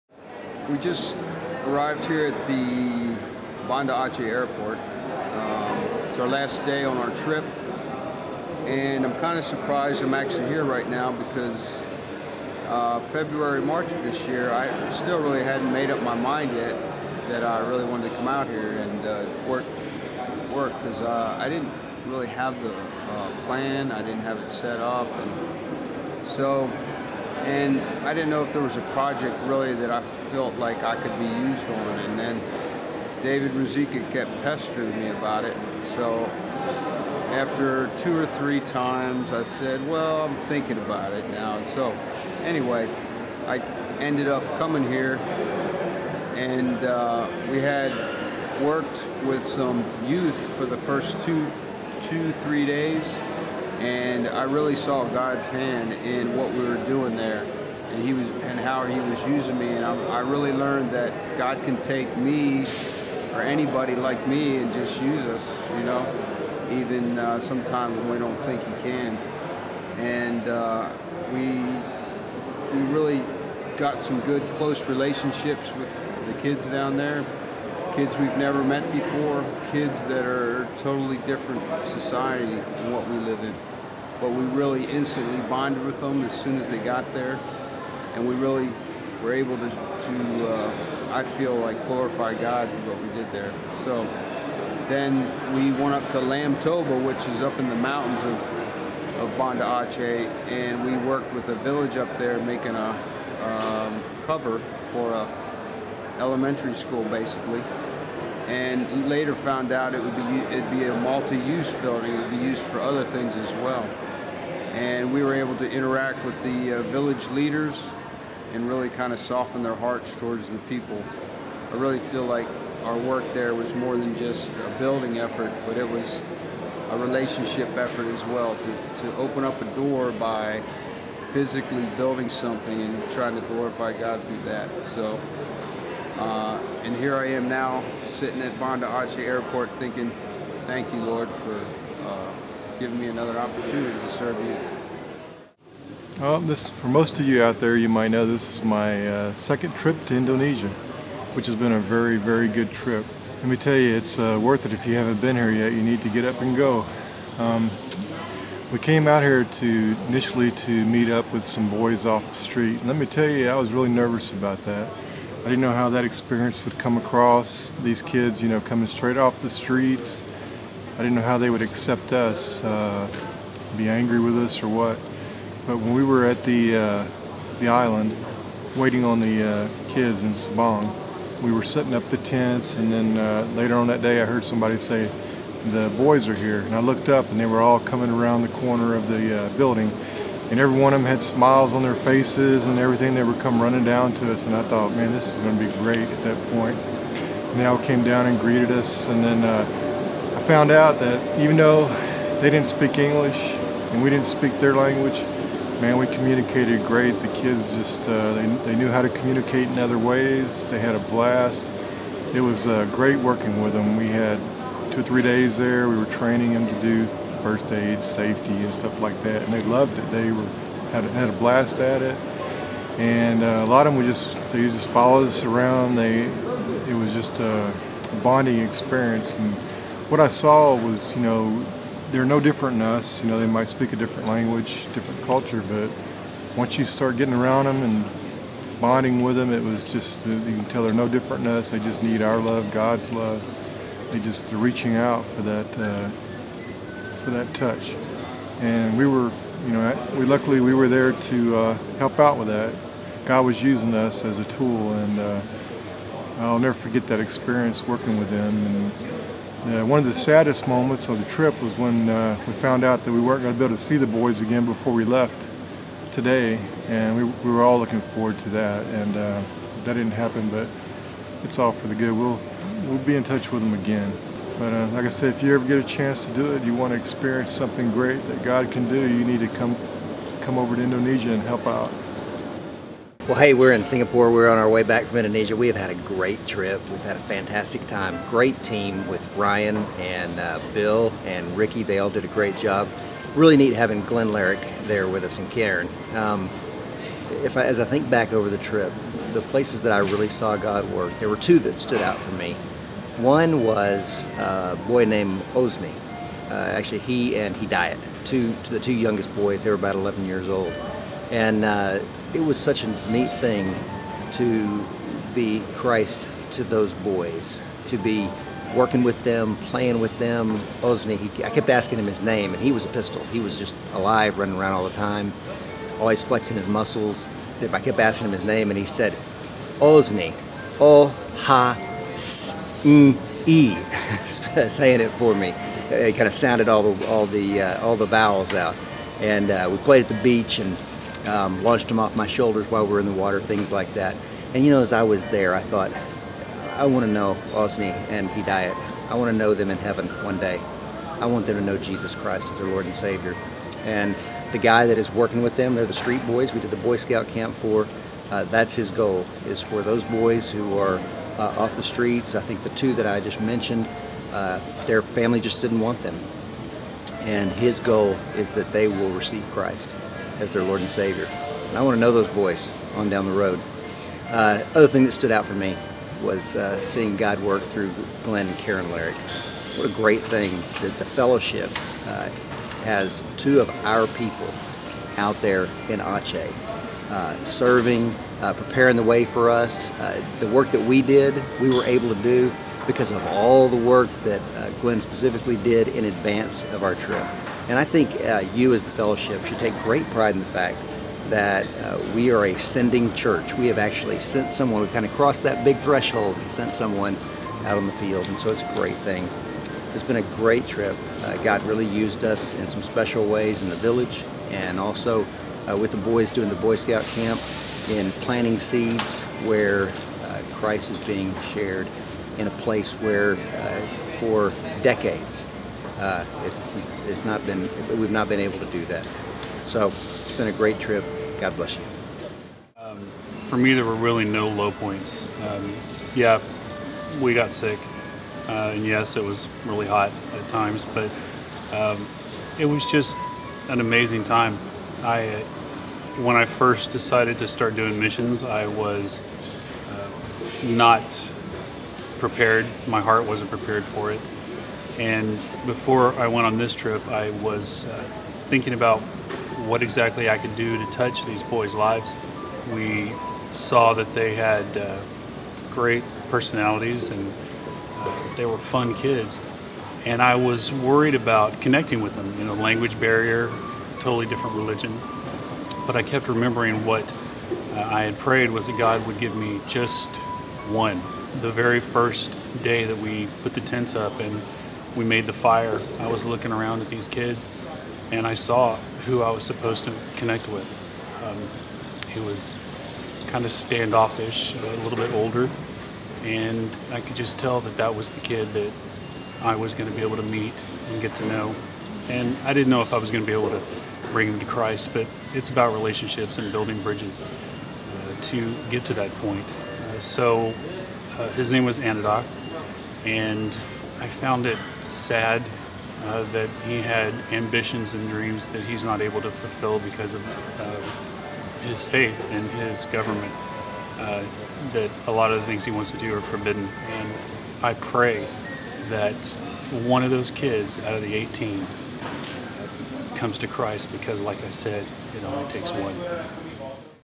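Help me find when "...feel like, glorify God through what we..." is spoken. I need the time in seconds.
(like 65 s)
91 s.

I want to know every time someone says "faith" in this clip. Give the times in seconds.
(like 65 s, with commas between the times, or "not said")
521 s.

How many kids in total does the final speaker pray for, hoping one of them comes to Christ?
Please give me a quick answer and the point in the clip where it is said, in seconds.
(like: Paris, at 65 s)
18, at 531 s.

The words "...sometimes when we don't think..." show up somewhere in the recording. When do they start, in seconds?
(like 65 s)
67 s.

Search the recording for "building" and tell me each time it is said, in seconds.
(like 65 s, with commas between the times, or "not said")
111 s, 124 s, 131 s, 189 s, 506 s.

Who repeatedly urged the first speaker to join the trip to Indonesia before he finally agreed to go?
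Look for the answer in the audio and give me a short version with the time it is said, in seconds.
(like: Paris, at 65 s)
David Ruzicka, at 33 s.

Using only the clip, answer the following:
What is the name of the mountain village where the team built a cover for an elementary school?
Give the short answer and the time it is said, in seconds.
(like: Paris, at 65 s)
Lamtoba, at 96 s.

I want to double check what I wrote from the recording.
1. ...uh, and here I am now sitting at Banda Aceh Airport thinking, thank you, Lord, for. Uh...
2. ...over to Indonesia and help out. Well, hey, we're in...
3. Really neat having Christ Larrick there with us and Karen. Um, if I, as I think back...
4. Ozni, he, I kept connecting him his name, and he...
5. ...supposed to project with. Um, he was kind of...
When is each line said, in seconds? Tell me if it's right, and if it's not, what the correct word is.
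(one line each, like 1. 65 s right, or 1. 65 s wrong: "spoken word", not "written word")
1. 136 s right
2. 280 s right
3. 293 s wrong: "Glenn", not "Christ"
4. 320 s wrong: "asking", not "connecting"
5. 489 s wrong: "connect", not "project".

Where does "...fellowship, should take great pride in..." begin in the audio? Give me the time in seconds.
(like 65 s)
398 s.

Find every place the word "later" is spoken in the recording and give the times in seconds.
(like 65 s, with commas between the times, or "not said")
109 s, 183 s.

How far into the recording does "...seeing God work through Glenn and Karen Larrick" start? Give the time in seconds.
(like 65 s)
376 s.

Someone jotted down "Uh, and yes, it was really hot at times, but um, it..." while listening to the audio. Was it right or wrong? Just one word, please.
right.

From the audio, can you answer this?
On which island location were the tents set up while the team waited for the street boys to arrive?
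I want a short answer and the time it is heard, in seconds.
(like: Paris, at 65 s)
Sabang, at 180 s.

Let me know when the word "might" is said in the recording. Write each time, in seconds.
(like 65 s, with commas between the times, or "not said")
147 s, 233 s.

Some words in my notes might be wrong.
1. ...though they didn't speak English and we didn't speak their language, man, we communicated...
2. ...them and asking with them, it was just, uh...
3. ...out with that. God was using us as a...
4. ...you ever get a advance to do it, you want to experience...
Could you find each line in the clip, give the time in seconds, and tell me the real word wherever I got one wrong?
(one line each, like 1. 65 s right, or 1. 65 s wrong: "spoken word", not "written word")
1. 201 s right
2. 237 s wrong: "bonding", not "asking"
3. 252 s right
4. 275 s wrong: "chance", not "advance".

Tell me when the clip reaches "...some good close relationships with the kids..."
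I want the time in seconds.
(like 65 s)
73 s.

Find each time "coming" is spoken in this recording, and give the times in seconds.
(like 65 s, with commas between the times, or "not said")
44 s, 168 s, 187 s.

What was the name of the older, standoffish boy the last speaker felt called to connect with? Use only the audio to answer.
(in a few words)
Anadoc.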